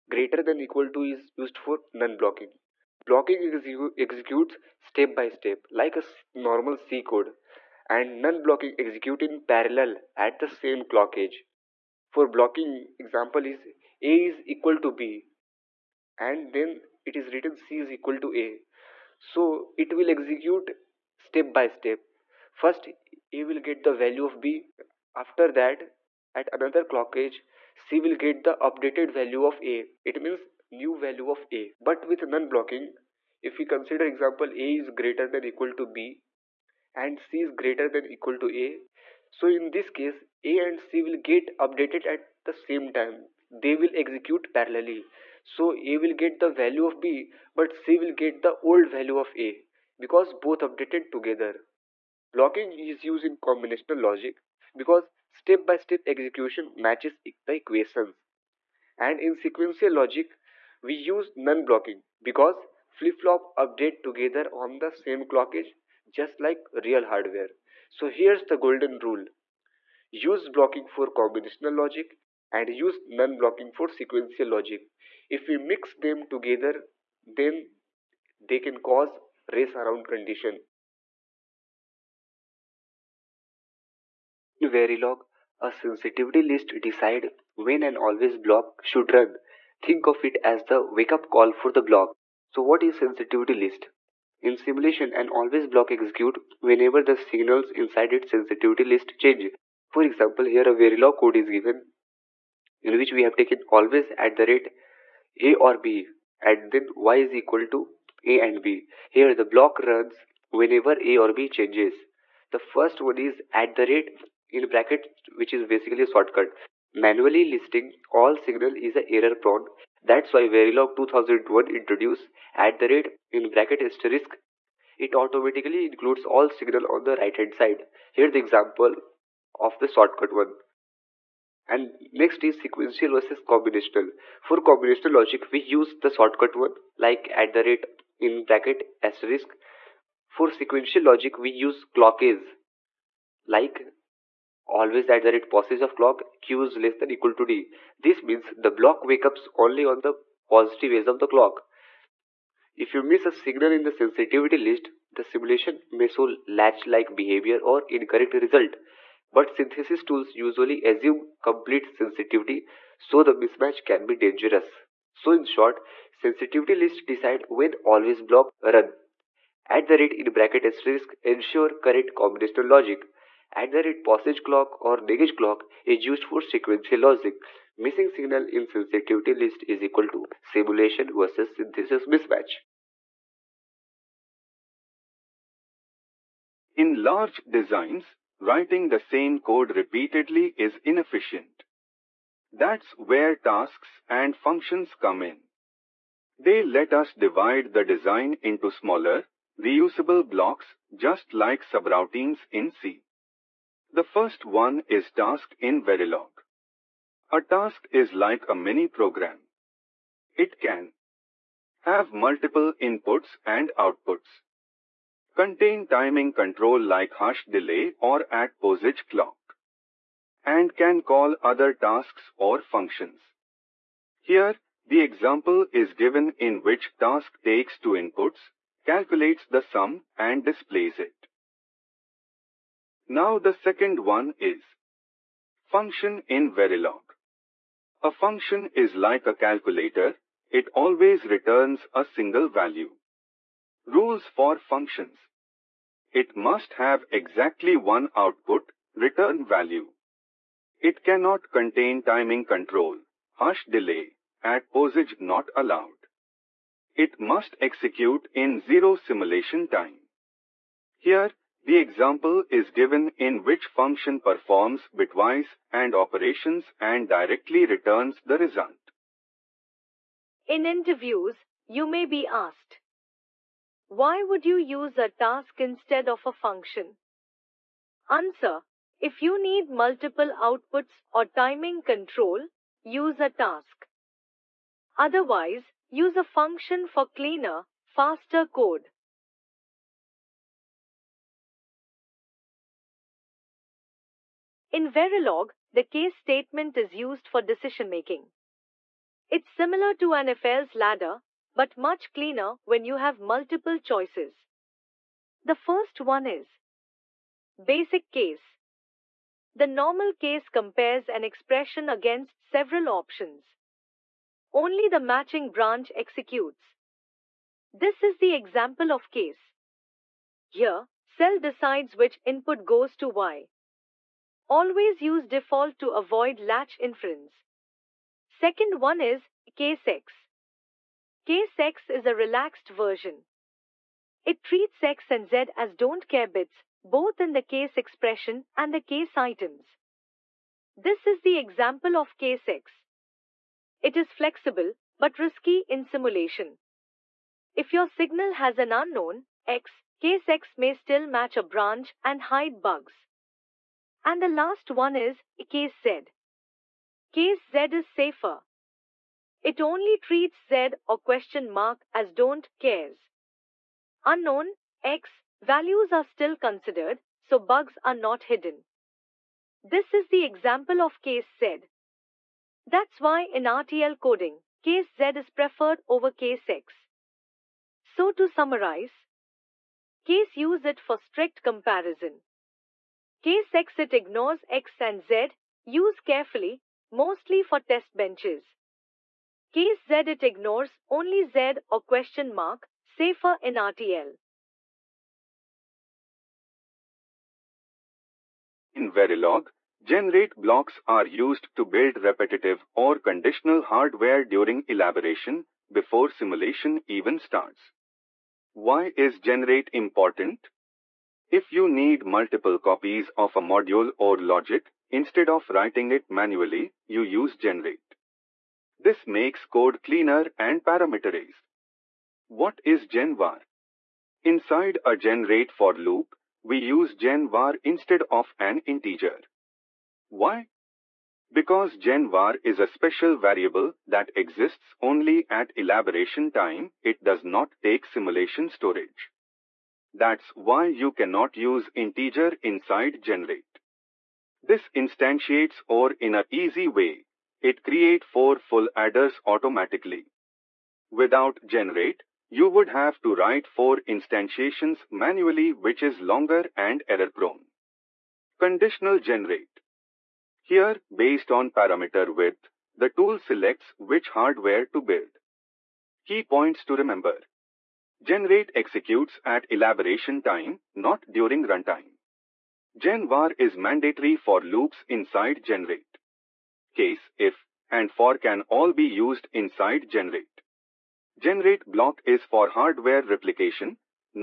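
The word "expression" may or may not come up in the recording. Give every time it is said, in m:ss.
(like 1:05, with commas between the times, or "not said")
5:11, 5:37.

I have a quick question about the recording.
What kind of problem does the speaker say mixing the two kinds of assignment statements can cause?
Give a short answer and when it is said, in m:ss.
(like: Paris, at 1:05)
race around condition, at 1:19.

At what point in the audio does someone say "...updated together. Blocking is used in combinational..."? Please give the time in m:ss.
0:50.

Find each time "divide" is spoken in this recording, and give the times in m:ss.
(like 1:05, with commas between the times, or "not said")
3:17.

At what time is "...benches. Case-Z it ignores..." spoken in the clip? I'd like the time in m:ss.
6:27.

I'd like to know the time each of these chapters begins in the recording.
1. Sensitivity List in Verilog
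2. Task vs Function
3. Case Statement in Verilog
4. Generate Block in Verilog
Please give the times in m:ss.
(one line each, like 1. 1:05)
1. 1:20
2. 3:02
3. 4:49
4. 6:34.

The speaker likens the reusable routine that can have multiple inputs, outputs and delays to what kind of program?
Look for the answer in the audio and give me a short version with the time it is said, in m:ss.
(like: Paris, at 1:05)
a mini program, at 3:28.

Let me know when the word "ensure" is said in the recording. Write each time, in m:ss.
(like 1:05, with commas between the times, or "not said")
2:51.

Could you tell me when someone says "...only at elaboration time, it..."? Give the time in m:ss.
7:14.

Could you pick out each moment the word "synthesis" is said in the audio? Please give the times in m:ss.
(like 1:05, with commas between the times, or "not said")
2:39, 3:01.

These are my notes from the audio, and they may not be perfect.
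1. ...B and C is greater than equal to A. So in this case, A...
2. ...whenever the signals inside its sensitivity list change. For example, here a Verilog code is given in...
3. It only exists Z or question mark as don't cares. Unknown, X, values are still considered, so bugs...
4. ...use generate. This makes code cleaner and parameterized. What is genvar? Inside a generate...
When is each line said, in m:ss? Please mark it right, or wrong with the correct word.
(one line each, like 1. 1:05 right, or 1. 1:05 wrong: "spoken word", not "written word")
1. 0:35 right
2. 1:36 right
3. 5:59 wrong: "treats", not "exists"
4. 6:57 right.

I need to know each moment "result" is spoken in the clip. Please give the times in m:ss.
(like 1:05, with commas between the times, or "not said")
2:38, 4:28.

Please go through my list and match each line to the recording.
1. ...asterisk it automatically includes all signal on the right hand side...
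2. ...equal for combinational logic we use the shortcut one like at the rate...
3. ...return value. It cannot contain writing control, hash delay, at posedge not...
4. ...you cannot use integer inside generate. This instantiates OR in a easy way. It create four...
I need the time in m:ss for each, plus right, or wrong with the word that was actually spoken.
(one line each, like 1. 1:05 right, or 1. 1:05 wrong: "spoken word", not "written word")
1. 2:03 right
2. 2:13 wrong: "combinational", not "equal"
3. 4:08 wrong: "timing", not "writing"
4. 7:20 right.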